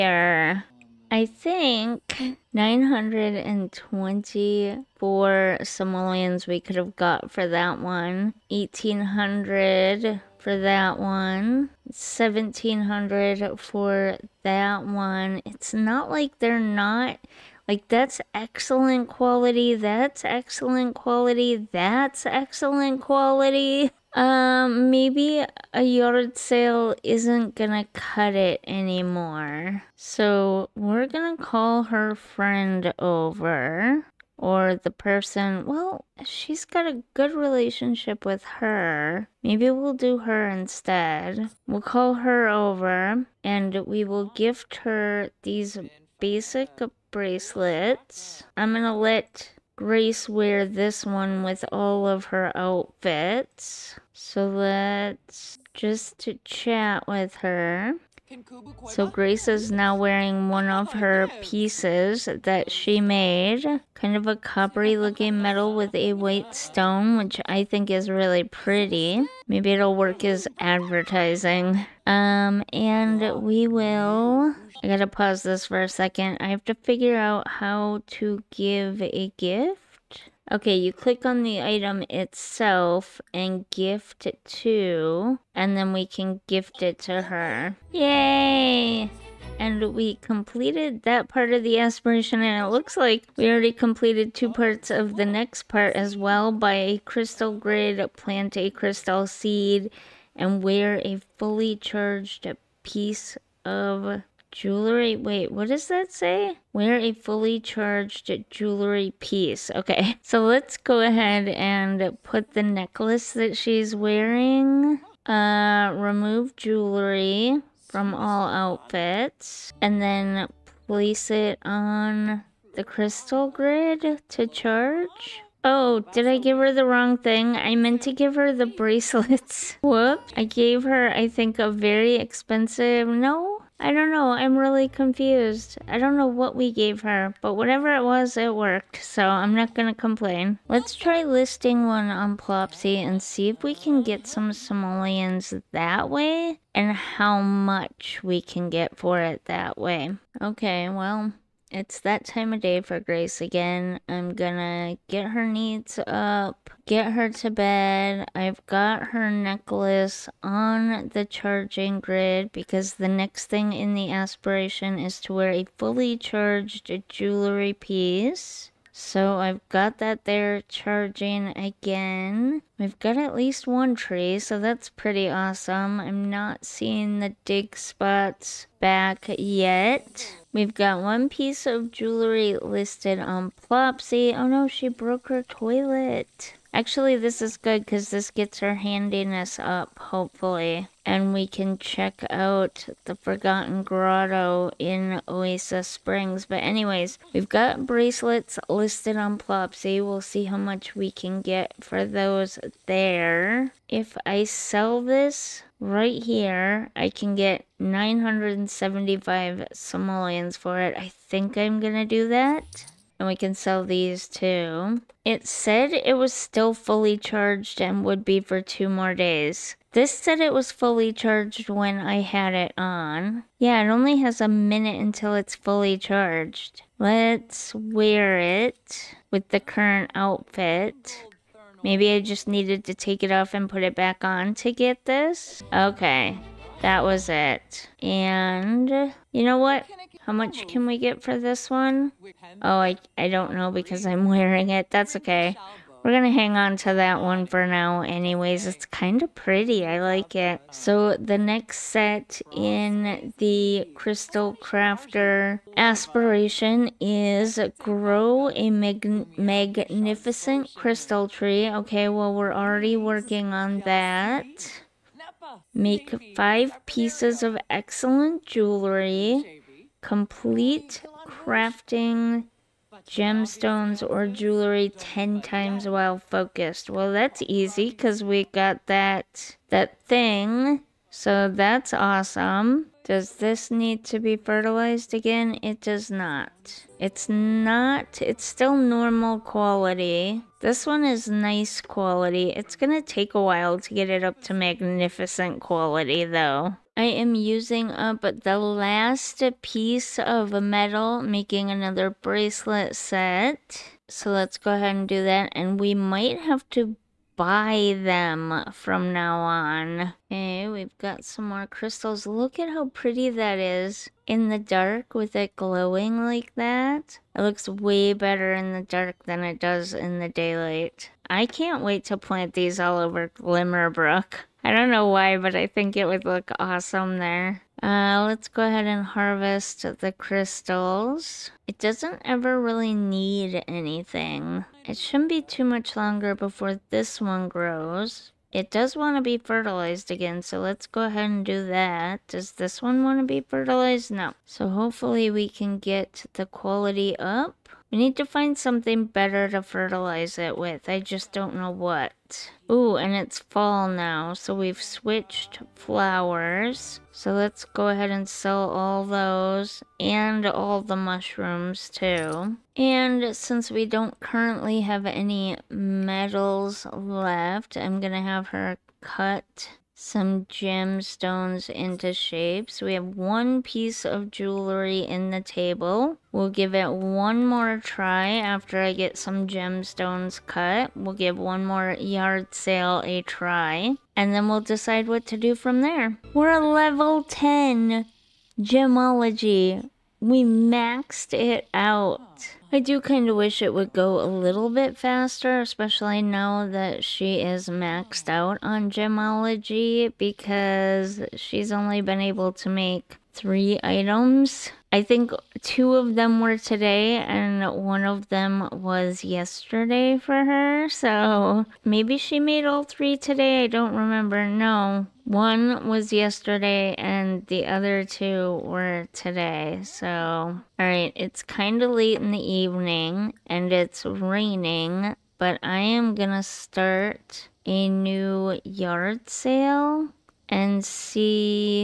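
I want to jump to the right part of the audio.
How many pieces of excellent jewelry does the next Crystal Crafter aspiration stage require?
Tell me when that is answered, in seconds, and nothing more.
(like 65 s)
266 s.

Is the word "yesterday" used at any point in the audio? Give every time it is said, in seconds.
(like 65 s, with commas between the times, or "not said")
409 s, 416 s.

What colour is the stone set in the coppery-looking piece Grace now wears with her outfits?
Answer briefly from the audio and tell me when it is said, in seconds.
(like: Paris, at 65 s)
white, at 66 s.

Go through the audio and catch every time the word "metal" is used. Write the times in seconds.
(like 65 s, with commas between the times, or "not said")
65 s, 300 s, 365 s.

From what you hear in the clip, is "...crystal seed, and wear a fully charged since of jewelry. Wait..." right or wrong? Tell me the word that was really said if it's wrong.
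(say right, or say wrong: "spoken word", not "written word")
wrong: "piece", not "since".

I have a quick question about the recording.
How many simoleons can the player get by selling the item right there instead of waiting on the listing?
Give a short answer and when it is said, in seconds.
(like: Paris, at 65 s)
975, at 207 s.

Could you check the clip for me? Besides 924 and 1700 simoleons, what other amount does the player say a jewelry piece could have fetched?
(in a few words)
1800.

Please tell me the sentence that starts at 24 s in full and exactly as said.
Um, maybe a yard sale isn't gonna cut it anymore.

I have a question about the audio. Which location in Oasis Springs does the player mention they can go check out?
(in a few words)
Forgotten Grotto.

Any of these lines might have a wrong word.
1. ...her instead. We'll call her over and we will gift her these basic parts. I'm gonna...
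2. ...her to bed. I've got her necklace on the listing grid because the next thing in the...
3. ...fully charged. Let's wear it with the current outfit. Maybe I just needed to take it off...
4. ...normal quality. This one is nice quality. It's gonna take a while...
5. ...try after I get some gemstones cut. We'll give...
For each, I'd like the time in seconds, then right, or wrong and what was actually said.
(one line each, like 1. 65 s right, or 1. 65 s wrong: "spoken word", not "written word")
1. 40 s wrong: "bracelets", not "parts"
2. 157 s wrong: "charging", not "listing"
3. 225 s right
4. 288 s right
5. 377 s right.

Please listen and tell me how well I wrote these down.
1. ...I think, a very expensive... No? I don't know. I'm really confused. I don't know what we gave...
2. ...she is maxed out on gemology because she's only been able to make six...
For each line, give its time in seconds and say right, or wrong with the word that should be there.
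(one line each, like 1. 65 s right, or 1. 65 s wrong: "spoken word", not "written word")
1. 131 s right
2. 397 s wrong: "three", not "six".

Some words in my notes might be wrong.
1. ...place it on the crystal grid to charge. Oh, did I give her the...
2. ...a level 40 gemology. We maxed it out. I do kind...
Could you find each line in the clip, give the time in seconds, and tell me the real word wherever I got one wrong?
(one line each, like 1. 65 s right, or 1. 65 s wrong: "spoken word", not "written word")
1. 120 s right
2. 386 s wrong: "10", not "40".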